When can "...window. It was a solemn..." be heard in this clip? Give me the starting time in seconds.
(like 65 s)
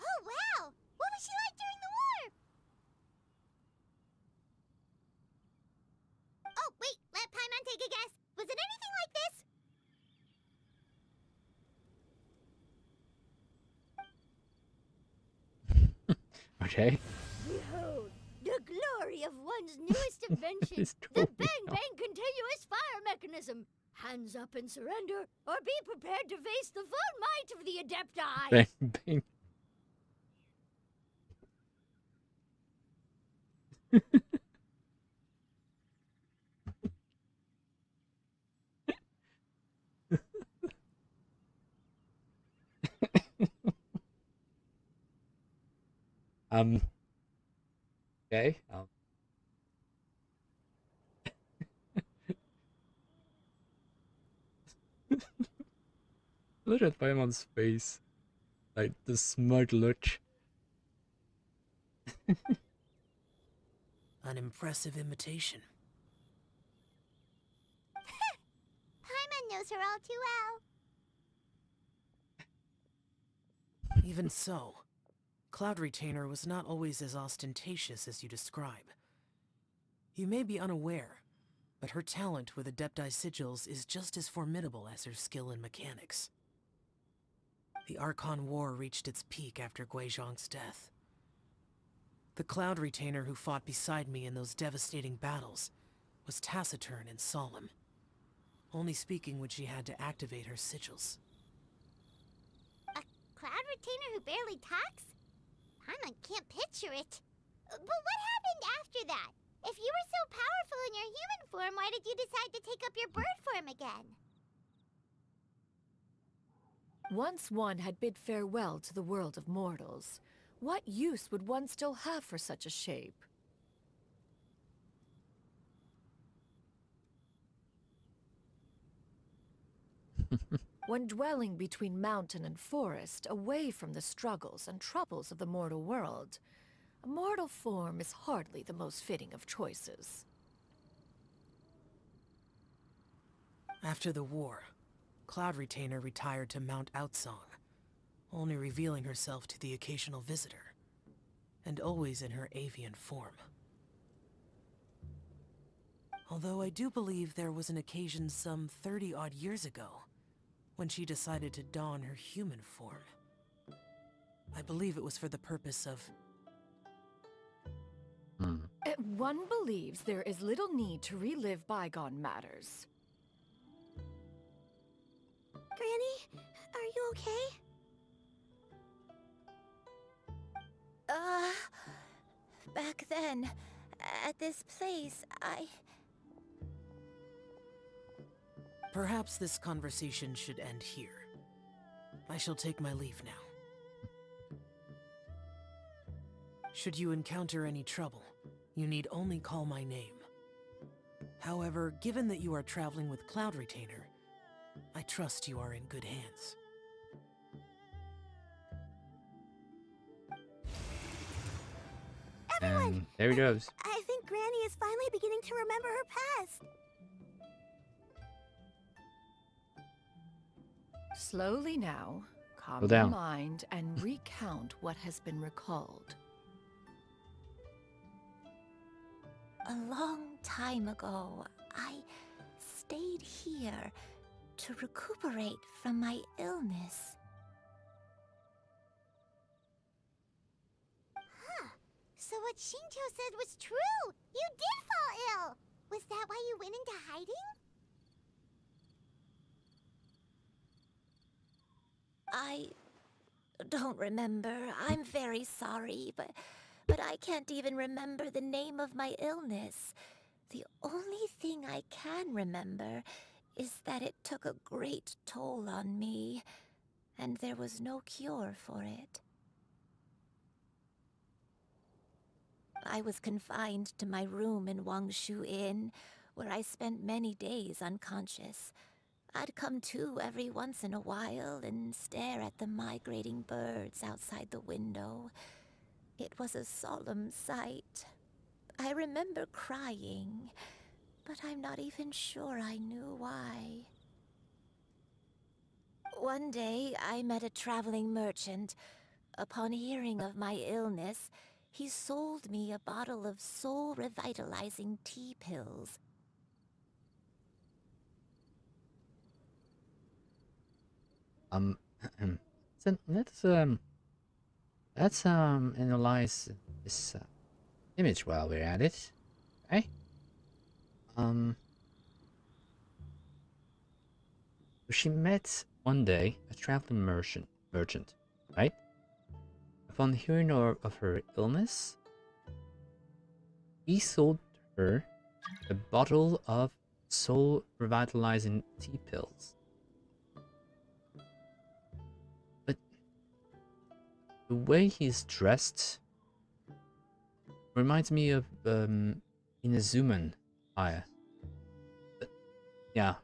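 284 s.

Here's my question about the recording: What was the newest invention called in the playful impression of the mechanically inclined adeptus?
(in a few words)
Bang Bang Continuous Fire Mechanism.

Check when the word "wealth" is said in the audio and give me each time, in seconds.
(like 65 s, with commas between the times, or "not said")
not said.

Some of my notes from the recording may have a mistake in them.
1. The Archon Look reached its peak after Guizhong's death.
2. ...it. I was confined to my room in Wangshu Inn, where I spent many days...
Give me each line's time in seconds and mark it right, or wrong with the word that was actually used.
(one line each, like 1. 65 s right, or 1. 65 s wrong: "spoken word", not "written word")
1. 87 s wrong: "War", not "Look"
2. 268 s right.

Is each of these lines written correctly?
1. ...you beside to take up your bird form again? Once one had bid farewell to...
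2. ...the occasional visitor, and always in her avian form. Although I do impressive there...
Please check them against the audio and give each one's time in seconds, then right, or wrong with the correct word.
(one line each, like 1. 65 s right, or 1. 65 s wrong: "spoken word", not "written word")
1. 112 s wrong: "decide", not "beside"
2. 149 s wrong: "believe", not "impressive".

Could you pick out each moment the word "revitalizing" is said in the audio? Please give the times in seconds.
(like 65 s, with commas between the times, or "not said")
303 s, 337 s.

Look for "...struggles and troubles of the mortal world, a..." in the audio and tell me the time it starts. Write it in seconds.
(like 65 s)
134 s.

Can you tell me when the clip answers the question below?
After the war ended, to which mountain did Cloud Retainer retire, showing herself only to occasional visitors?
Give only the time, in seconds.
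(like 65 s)
146 s.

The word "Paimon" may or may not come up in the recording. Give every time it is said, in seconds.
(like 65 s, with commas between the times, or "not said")
56 s, 69 s.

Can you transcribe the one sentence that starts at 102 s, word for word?
A Cloud Retainer who barely talks?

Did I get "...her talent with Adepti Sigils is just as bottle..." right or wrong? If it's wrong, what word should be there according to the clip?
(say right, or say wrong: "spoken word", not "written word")
wrong: "formidable", not "bottle".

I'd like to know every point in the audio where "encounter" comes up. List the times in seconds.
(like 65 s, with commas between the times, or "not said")
197 s.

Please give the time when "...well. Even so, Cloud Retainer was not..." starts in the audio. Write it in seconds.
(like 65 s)
74 s.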